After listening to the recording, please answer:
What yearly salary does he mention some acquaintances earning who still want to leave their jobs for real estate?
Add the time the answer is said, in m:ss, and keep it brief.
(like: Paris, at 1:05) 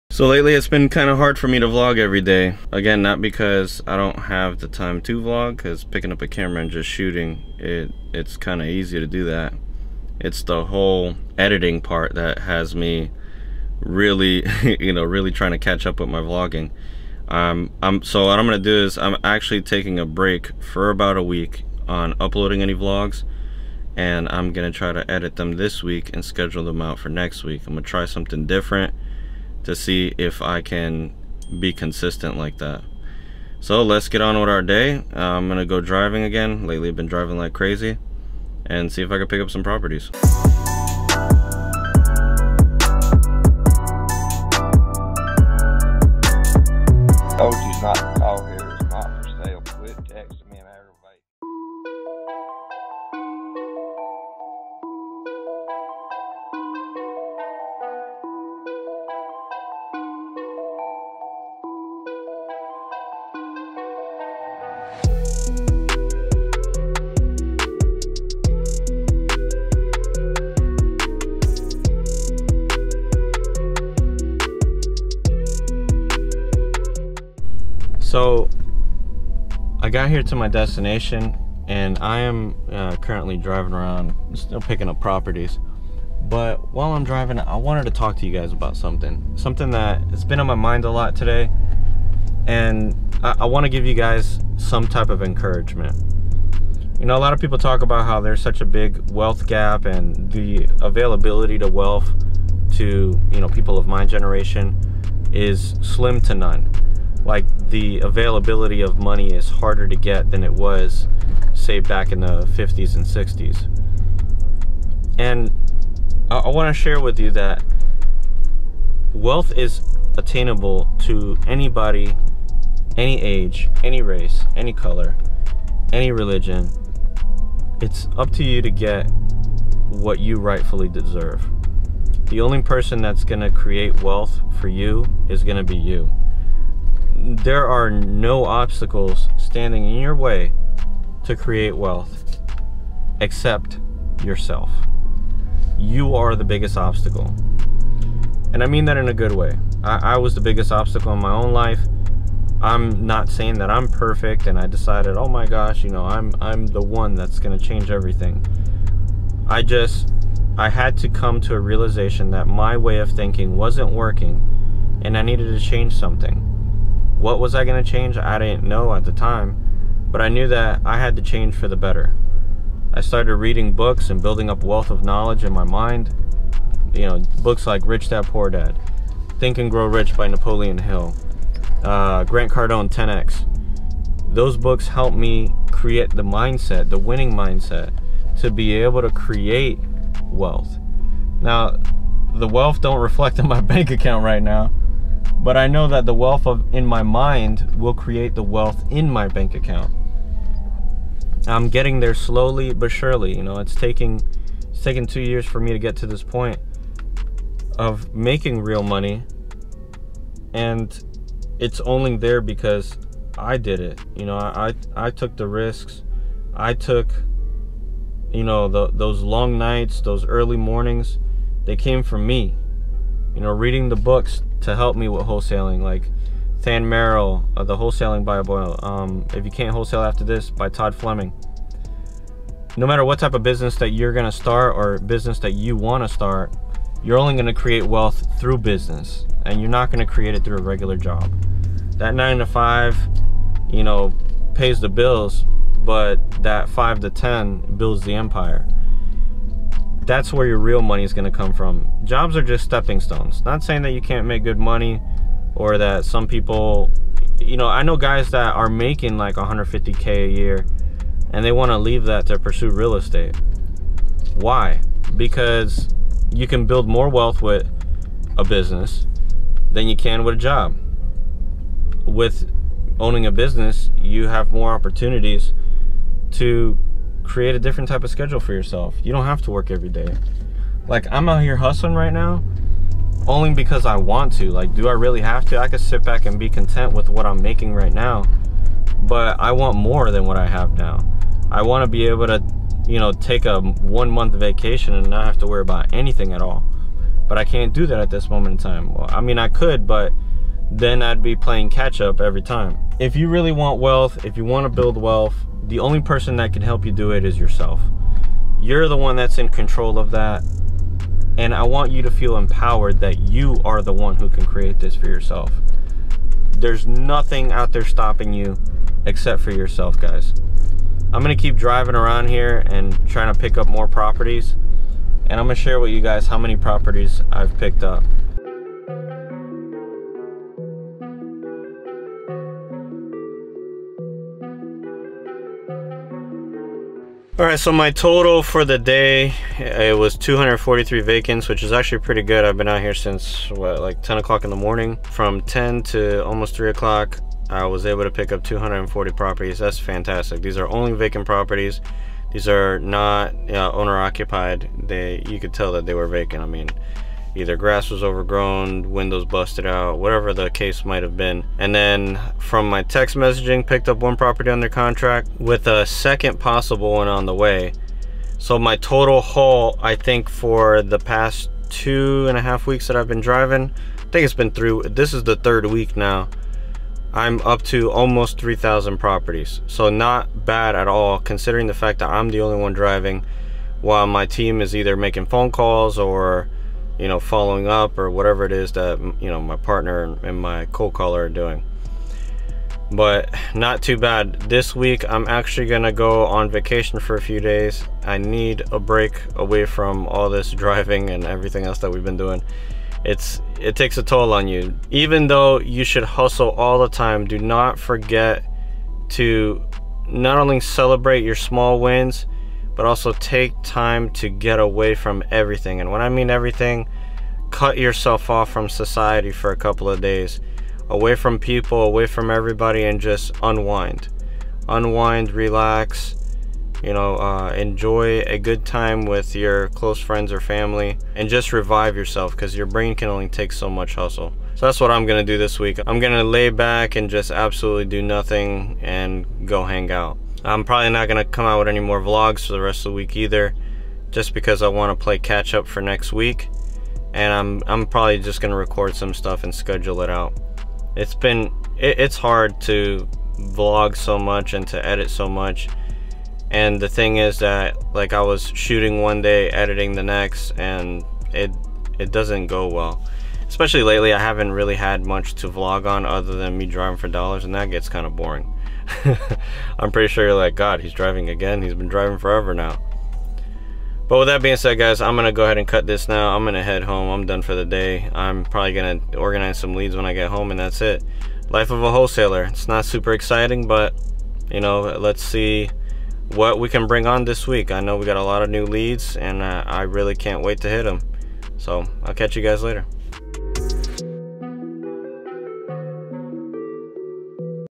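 150K, at 4:19.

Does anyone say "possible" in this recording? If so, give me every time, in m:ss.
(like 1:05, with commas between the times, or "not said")
6:06.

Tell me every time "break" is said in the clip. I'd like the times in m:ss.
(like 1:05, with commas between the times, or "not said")
0:20, 6:38.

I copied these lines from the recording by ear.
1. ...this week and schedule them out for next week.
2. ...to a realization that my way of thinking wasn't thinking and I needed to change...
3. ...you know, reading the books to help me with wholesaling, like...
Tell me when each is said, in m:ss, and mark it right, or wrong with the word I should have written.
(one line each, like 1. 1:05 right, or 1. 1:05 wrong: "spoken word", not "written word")
1. 0:25 right
2. 2:41 wrong: "working", not "thinking"
3. 3:43 right.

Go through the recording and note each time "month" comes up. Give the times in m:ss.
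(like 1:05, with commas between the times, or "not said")
4:54.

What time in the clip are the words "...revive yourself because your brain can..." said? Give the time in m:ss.
7:11.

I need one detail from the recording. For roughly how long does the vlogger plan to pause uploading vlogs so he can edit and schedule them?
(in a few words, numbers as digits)
a week.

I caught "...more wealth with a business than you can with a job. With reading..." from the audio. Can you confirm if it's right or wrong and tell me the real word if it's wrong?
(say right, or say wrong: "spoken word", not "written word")
wrong: "owning", not "reading".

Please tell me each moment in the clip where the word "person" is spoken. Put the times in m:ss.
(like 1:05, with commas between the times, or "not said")
2:12, 5:06.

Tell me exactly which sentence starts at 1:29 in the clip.
Something that has been on my mind a lot today.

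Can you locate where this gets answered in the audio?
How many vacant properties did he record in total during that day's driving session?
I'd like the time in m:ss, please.
5:40.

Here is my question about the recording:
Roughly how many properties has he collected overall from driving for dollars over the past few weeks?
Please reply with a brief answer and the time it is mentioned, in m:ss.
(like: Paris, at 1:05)
almost 3,000, at 6:17.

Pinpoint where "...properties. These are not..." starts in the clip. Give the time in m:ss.
5:51.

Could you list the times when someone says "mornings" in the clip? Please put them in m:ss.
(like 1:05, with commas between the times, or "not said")
3:40, 5:44.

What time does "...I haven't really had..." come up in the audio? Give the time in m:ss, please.
7:44.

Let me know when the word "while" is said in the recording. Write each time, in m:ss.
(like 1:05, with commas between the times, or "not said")
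1:26, 6:23.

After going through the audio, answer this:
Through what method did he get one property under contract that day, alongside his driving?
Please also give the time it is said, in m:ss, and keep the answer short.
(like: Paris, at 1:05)
text messaging, at 6:02.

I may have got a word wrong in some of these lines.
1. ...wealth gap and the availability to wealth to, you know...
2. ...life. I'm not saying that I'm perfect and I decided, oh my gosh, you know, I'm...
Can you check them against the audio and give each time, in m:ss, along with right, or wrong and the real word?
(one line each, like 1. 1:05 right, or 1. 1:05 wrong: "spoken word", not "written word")
1. 1:39 right
2. 2:31 right.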